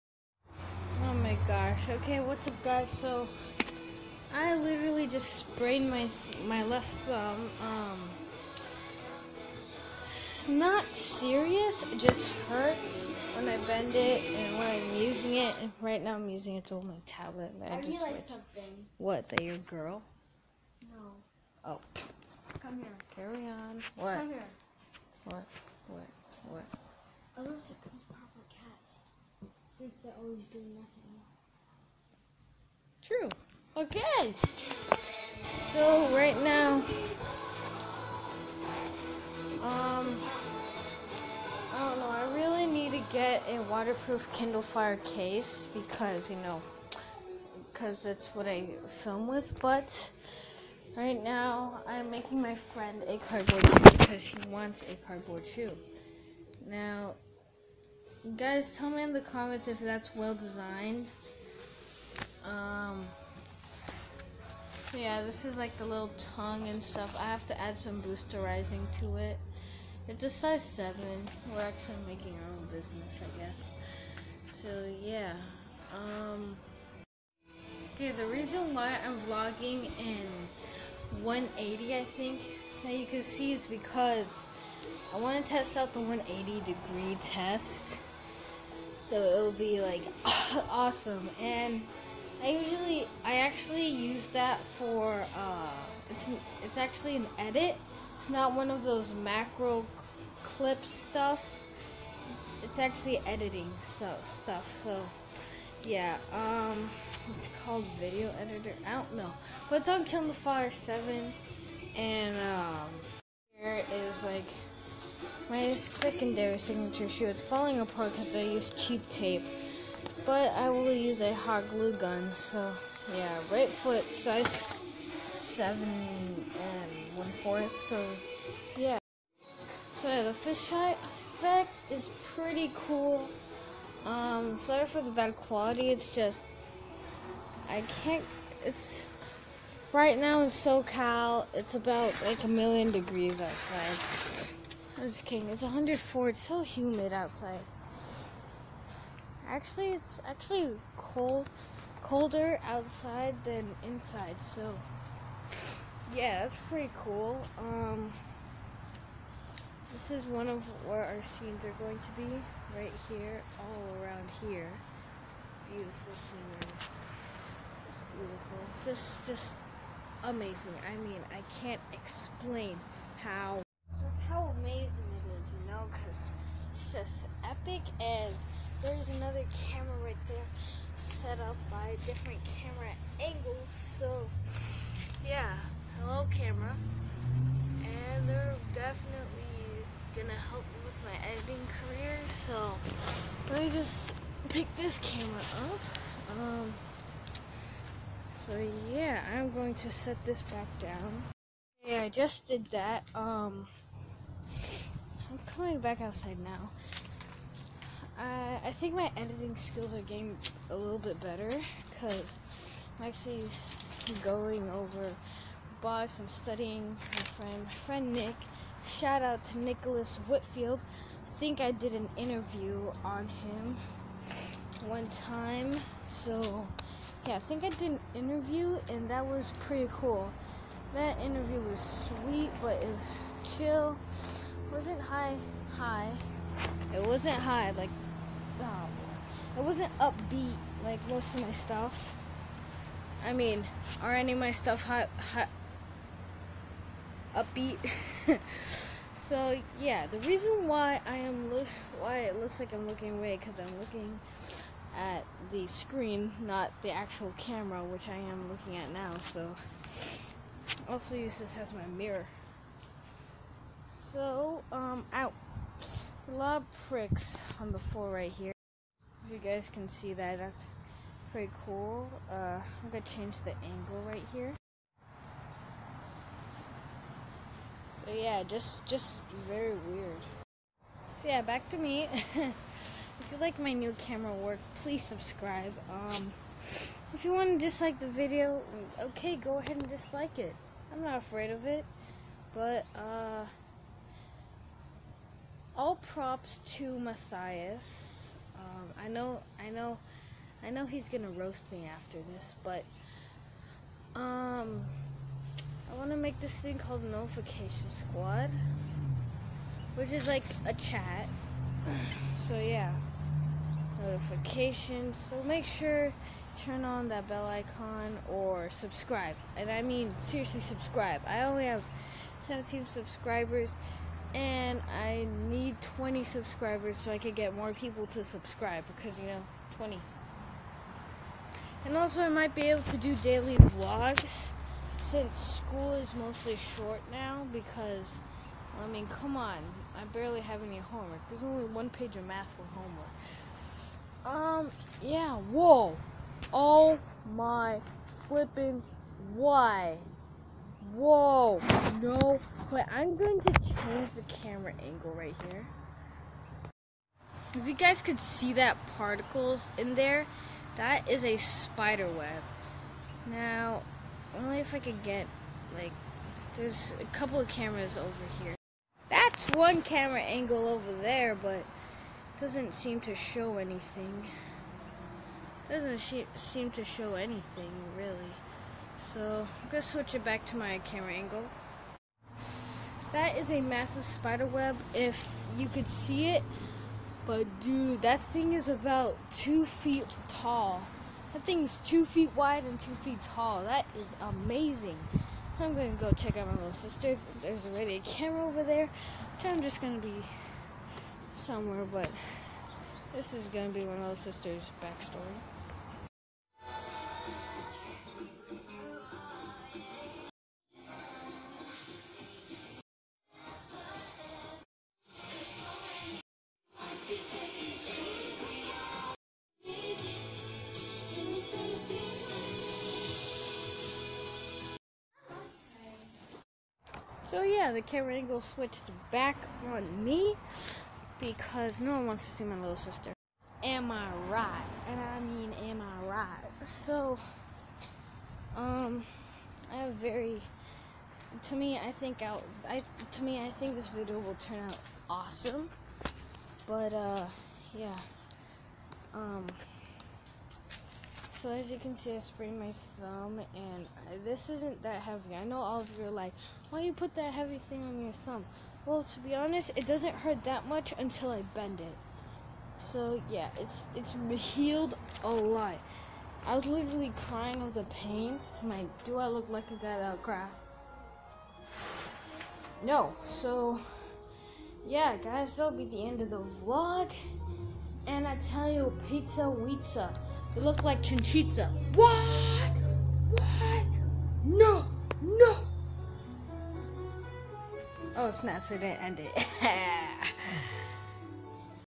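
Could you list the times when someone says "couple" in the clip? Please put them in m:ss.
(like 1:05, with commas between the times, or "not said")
6:07.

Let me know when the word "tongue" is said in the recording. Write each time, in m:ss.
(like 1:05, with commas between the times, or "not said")
1:06.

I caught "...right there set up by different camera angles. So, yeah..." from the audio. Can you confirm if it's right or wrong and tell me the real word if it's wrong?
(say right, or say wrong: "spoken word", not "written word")
right.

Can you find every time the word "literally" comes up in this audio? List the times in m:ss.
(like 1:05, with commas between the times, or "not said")
0:04, 7:46.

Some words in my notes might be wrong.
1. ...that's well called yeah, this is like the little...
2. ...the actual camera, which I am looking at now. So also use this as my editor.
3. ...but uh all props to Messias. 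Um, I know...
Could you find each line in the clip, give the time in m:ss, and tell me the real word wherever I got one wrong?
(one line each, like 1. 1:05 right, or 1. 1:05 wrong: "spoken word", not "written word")
1. 0:59 wrong: "designed", not "called"
2. 4:16 wrong: "mirror", not "editor"
3. 4:52 right.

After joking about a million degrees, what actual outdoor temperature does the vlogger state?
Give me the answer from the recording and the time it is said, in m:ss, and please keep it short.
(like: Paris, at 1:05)
104, at 2:25.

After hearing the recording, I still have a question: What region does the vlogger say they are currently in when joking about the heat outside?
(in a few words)
SoCal.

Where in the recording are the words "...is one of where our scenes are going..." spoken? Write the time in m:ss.
2:40.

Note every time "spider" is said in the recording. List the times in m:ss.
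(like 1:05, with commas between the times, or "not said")
6:01, 6:24.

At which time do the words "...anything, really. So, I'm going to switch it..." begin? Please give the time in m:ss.
6:17.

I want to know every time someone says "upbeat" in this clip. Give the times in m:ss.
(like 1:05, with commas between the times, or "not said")
3:59, 4:07.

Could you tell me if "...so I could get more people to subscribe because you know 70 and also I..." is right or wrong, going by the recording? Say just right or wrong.
wrong.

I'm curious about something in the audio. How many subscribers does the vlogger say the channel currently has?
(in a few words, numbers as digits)
17.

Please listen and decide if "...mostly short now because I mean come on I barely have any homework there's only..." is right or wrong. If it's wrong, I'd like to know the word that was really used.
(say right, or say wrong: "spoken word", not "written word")
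right.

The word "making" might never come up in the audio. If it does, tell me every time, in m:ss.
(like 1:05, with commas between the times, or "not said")
0:52, 1:12.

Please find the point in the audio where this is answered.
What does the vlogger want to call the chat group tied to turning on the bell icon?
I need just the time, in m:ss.
5:07.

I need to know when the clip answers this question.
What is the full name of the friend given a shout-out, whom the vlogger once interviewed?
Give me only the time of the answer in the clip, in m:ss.
3:39.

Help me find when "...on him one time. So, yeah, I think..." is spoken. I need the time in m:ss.
3:43.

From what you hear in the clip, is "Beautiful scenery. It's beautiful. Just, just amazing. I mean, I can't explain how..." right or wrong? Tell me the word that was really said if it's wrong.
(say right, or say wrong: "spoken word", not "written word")
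right.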